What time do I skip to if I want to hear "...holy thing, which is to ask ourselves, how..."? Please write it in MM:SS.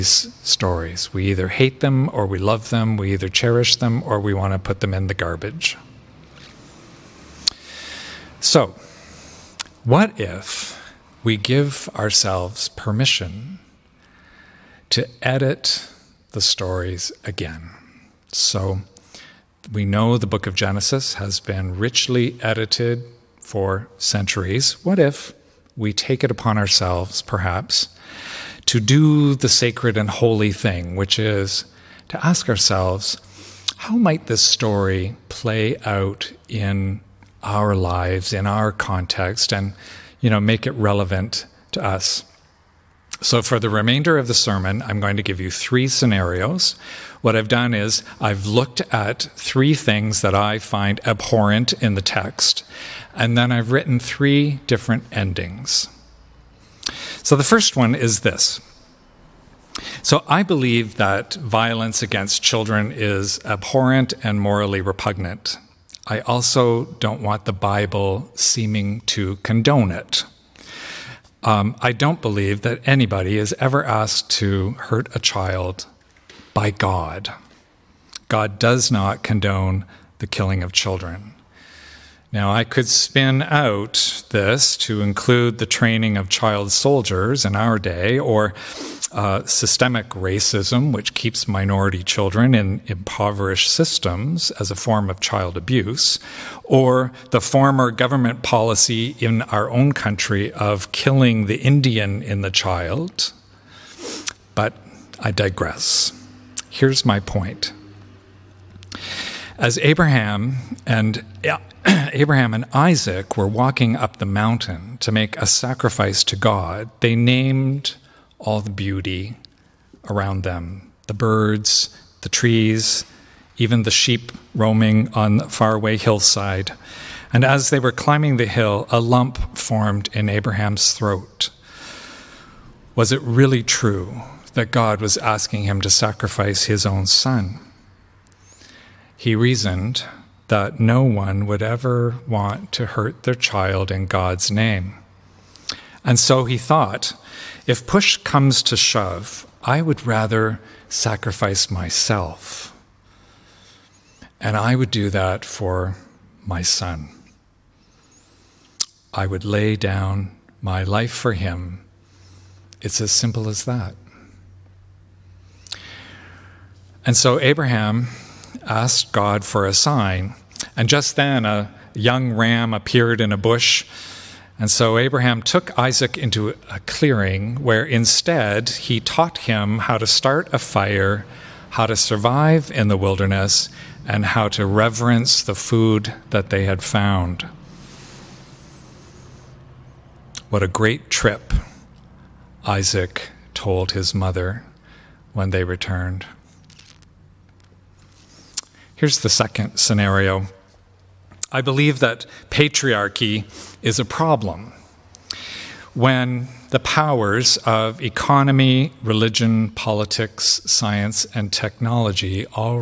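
00:30.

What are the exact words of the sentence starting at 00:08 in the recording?
So, what if we give ourselves permission to edit the stories again?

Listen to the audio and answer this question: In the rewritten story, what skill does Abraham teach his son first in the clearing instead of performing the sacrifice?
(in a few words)
How to start a fire.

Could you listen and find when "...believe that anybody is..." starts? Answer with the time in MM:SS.
01:12.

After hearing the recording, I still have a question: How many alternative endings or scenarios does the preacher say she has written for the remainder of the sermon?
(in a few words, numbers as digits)
3.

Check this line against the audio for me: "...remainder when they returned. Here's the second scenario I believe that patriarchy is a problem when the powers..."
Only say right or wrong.
wrong.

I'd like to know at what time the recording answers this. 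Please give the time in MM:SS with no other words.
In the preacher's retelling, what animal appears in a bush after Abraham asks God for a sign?
02:51.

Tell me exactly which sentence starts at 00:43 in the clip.
So, for the remainder of the sermon, I'm going to give you three scenarios.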